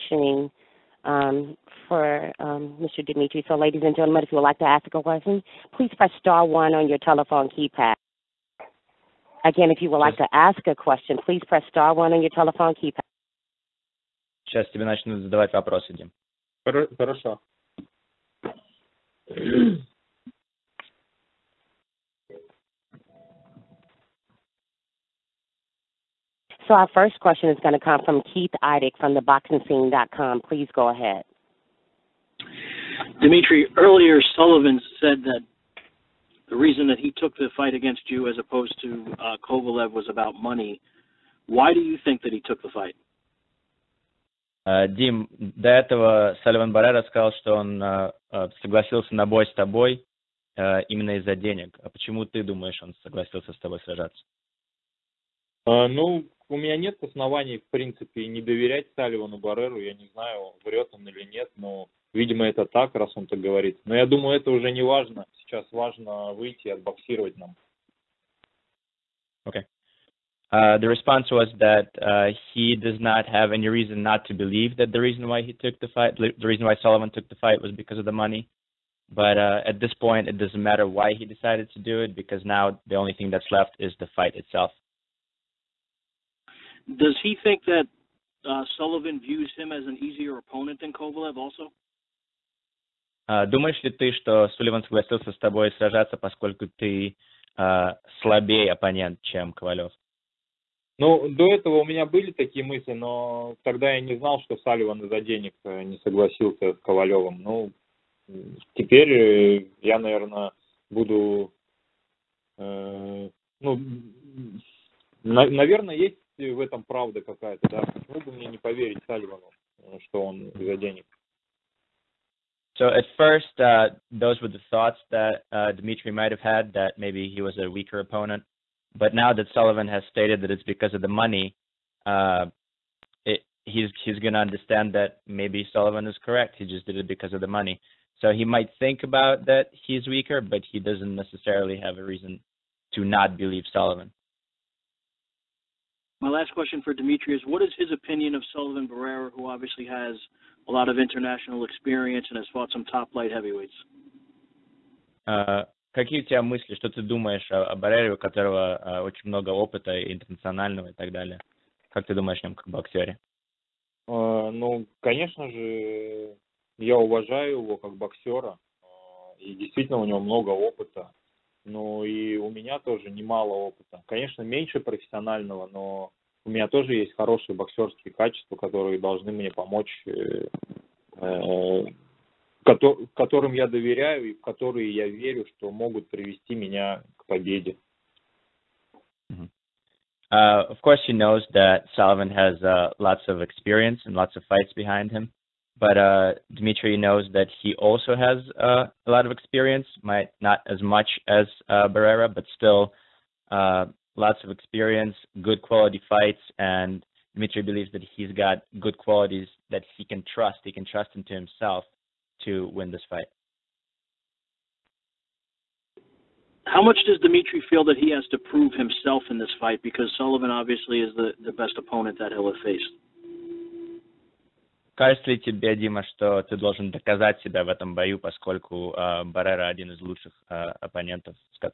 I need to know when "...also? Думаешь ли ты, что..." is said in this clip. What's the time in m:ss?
1:31.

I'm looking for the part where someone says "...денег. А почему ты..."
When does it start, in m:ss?
0:51.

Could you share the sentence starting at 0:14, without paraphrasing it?
Сейчас тебе начнут задавать вопросы, Дим.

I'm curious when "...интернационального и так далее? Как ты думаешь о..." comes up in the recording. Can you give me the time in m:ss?
2:40.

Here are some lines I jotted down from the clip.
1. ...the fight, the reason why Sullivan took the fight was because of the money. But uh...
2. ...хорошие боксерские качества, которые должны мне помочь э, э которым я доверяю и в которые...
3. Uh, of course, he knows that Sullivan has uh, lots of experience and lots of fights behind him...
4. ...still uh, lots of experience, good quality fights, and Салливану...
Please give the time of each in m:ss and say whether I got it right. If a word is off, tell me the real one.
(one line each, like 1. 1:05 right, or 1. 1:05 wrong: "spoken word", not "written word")
1. 1:15 right
2. 2:57 right
3. 3:10 right
4. 3:22 wrong: "Dmitry", not "Салливану".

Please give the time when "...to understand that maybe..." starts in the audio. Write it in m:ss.
2:14.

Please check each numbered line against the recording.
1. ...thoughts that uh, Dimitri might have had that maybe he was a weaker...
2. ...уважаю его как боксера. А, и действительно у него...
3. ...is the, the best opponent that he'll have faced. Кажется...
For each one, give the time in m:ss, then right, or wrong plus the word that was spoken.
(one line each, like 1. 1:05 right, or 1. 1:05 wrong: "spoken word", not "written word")
1. 2:04 wrong: "Dmitry", not "Dimitri"
2. 2:46 right
3. 3:41 right.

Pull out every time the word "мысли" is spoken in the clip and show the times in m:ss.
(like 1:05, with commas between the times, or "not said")
1:42, 2:36.